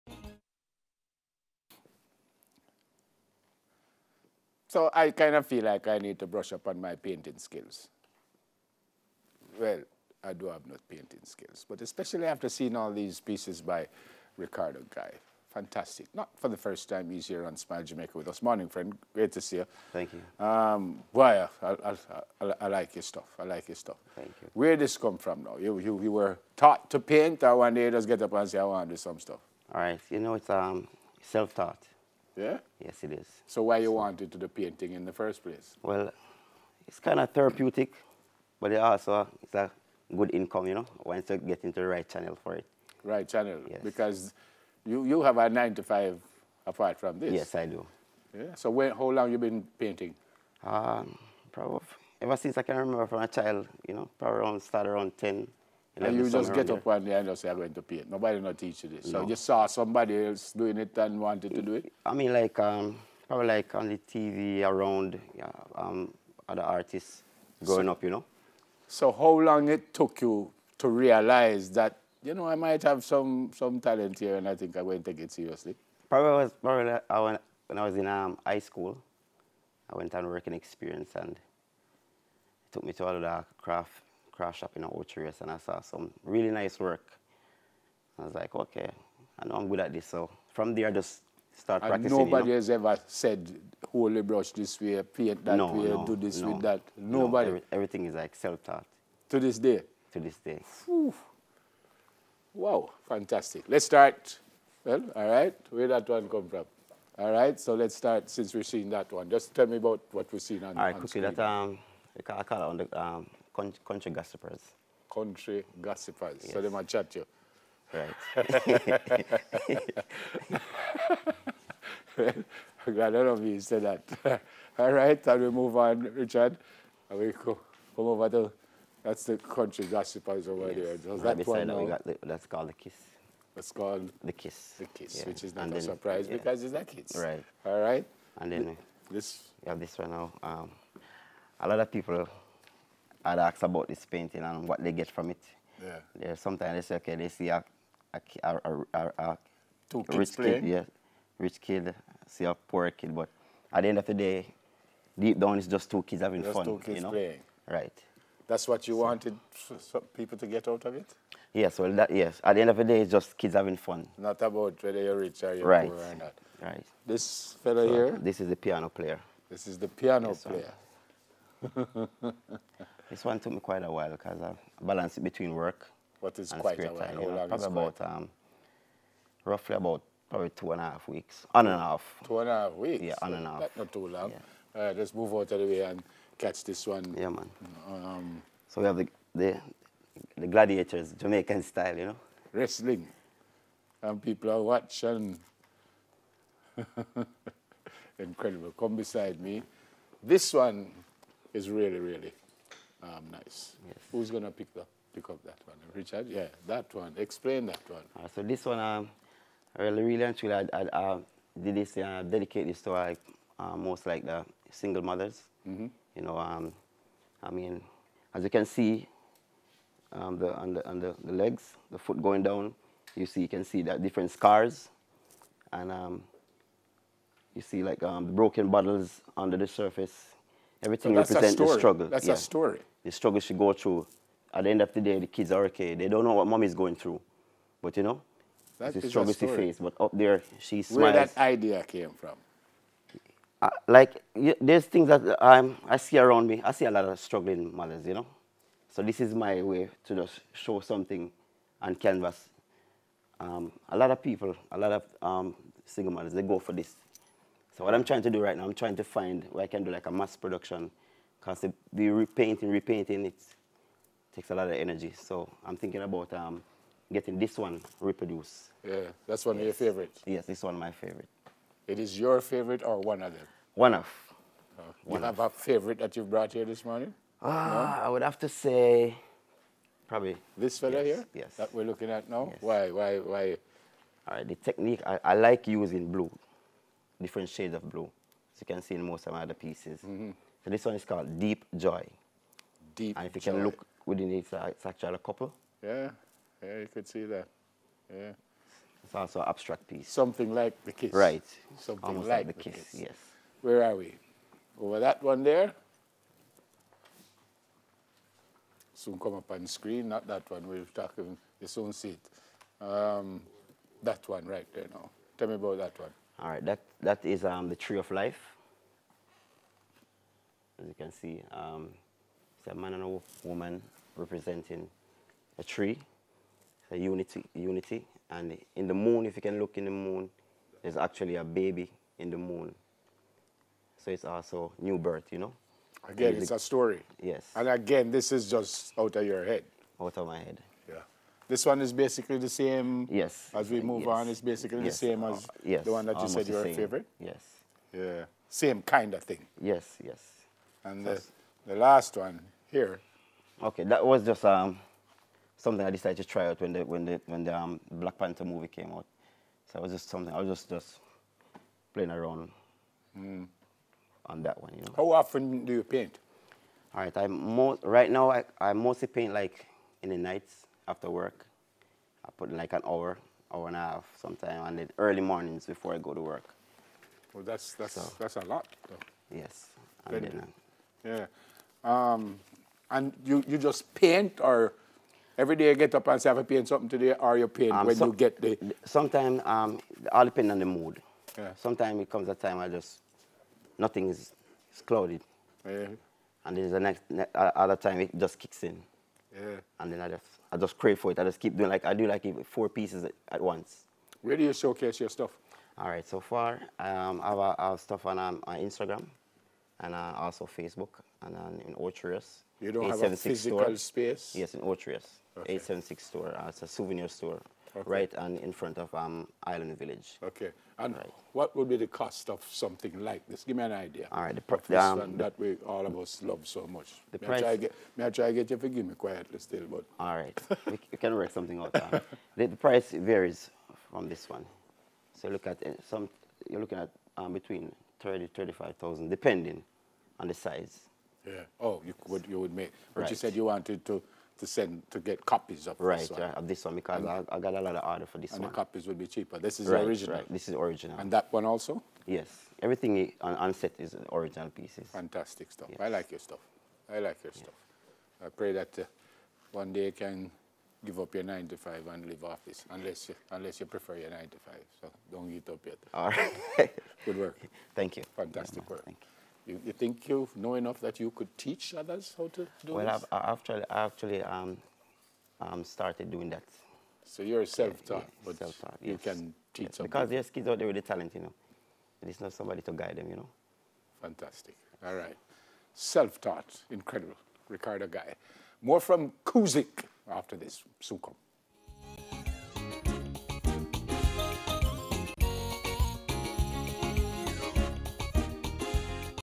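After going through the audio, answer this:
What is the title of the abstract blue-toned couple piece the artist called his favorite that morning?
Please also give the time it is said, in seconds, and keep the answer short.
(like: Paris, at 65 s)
Deep Joy, at 291 s.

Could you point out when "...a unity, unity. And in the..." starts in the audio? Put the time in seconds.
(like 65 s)
326 s.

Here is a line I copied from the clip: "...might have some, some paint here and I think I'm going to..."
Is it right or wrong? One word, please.
wrong.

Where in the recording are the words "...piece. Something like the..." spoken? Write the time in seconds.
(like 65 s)
299 s.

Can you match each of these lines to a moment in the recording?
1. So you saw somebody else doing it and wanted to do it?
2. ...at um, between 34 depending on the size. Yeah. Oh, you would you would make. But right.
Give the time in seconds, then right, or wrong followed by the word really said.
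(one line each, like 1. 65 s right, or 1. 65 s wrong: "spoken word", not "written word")
1. 59 s right
2. 436 s wrong: "30", not "34".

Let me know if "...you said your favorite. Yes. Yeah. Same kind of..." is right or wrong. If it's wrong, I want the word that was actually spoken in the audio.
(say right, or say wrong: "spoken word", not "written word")
right.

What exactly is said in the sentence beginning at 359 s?
So it was just something I was just just playing around mm.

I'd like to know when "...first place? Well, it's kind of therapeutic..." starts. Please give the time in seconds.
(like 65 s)
35 s.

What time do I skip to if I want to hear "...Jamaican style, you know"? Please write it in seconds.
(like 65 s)
191 s.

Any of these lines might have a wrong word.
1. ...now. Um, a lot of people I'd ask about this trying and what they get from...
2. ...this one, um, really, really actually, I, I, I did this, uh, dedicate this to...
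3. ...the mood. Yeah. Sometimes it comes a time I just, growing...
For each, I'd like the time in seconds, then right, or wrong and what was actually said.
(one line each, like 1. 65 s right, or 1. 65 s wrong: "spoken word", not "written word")
1. 140 s wrong: "painting", not "trying"
2. 208 s right
3. 390 s wrong: "nothing", not "growing".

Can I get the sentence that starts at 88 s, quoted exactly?
I was like, okay, I know I'm good at this.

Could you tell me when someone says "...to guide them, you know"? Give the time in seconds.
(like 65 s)
482 s.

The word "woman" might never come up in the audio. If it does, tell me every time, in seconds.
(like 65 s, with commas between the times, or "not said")
323 s.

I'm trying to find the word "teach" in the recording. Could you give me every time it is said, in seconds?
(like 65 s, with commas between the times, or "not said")
58 s, 471 s, 479 s.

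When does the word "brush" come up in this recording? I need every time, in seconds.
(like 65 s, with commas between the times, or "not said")
6 s, 94 s.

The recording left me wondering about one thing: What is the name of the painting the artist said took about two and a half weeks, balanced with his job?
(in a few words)
The Piano Player.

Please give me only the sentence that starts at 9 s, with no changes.
Well, I do have no painting skills, but especially after seeing all these pieces by Ricardo Guy.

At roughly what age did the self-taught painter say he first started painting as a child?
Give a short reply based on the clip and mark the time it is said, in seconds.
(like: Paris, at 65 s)
10, at 55 s.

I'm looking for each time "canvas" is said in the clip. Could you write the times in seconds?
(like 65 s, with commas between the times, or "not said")
251 s.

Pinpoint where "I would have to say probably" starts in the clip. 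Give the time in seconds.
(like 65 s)
278 s.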